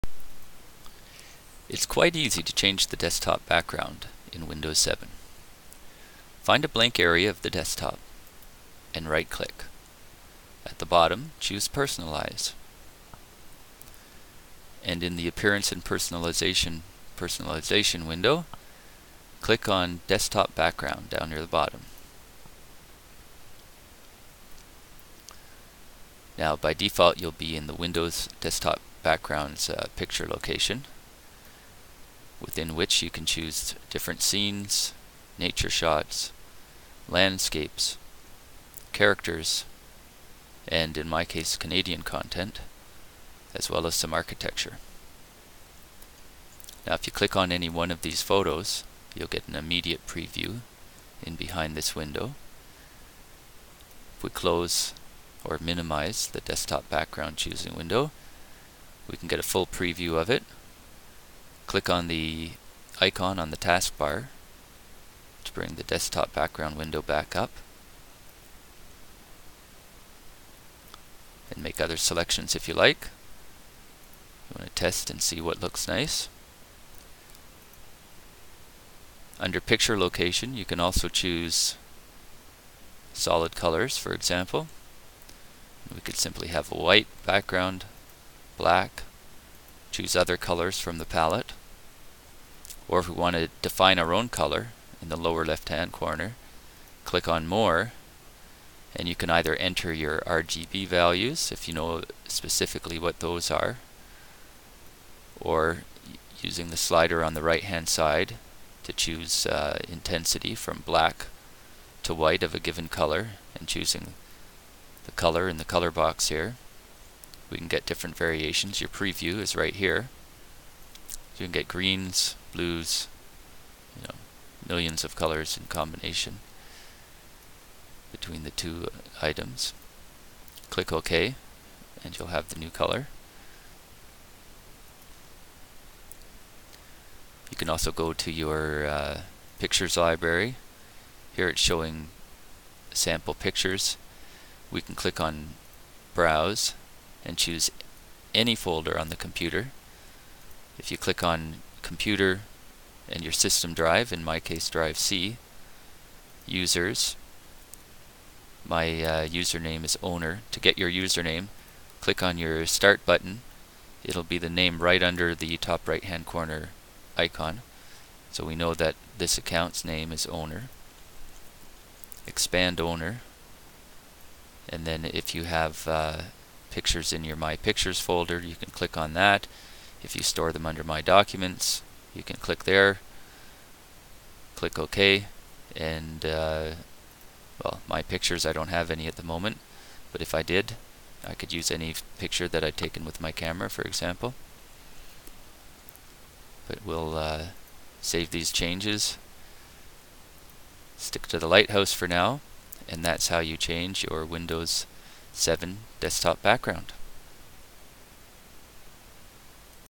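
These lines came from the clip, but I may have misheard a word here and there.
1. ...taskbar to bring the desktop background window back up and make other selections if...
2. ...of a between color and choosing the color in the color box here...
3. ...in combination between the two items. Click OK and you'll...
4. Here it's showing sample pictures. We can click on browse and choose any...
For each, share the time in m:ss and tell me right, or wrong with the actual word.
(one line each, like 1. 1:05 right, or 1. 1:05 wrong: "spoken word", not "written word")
1. 1:03 right
2. 1:52 wrong: "given", not "between"
3. 2:05 right
4. 2:21 right.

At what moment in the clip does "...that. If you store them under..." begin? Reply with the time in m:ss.
2:59.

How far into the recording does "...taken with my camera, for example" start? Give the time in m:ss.
3:12.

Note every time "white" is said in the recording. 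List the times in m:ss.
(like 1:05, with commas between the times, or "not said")
1:26, 1:52.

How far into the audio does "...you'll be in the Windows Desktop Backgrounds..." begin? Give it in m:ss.
0:27.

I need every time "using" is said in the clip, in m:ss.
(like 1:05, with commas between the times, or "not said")
1:46.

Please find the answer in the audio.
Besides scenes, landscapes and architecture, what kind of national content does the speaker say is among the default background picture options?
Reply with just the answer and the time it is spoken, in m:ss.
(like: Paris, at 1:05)
Canadian content, at 0:41.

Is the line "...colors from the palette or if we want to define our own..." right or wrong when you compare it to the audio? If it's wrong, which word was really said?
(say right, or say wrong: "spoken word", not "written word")
right.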